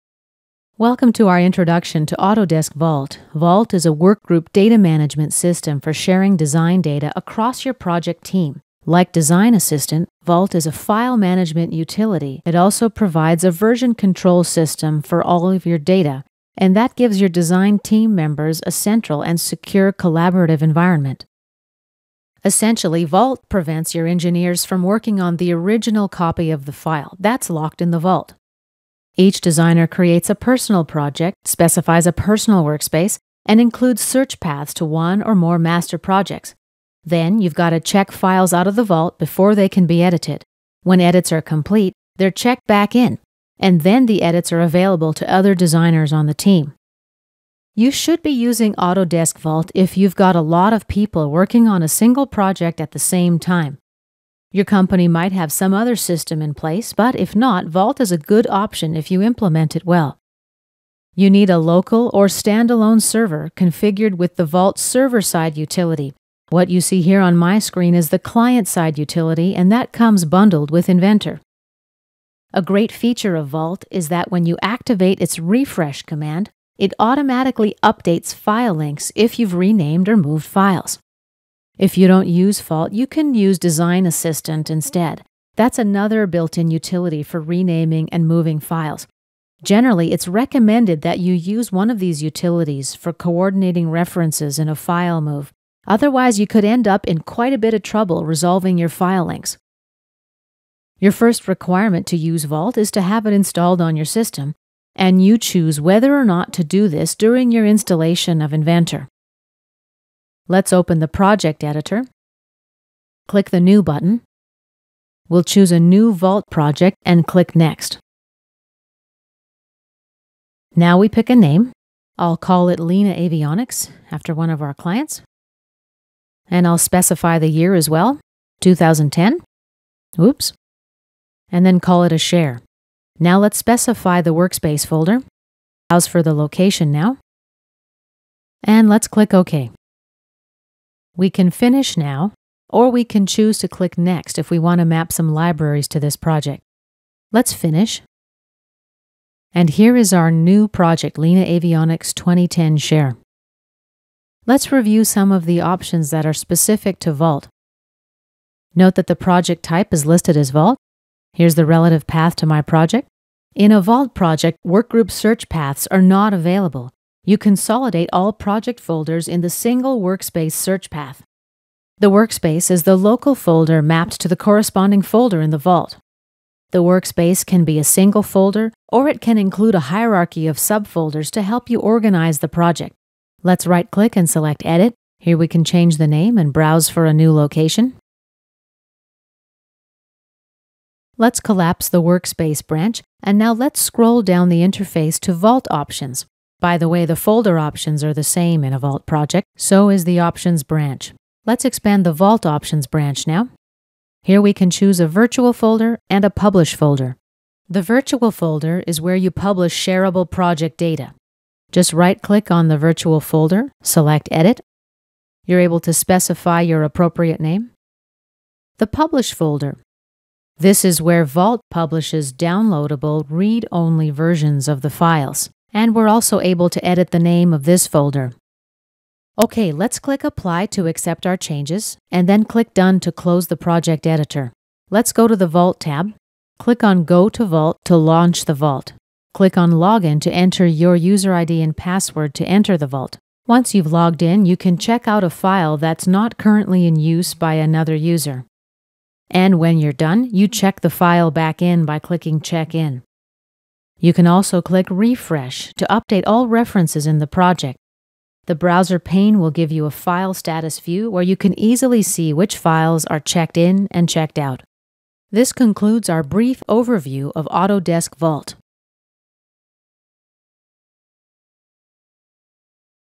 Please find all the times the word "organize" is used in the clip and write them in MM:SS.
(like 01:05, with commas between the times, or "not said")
03:01.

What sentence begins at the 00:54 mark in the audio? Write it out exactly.
Your company might have some other system in place, but if not, Vault is a good option if you implement it well.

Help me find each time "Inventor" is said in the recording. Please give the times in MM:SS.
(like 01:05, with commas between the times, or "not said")
01:10, 01:48.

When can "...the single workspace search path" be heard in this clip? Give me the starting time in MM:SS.
02:49.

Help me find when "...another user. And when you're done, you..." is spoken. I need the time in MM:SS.
04:07.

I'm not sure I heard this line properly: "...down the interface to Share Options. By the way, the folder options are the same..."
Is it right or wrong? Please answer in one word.
wrong.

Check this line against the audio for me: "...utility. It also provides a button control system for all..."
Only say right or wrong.
wrong.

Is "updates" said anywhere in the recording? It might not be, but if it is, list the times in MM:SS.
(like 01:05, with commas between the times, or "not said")
01:17, 04:15.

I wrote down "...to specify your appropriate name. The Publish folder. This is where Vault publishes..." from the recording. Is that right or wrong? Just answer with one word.
right.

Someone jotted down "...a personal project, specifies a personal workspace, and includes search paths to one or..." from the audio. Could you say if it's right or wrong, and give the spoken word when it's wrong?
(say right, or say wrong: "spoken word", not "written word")
right.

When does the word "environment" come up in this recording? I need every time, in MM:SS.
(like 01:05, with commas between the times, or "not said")
00:20.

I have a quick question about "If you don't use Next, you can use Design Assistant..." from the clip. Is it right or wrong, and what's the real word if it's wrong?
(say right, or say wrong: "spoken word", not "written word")
wrong: "Vault", not "Next".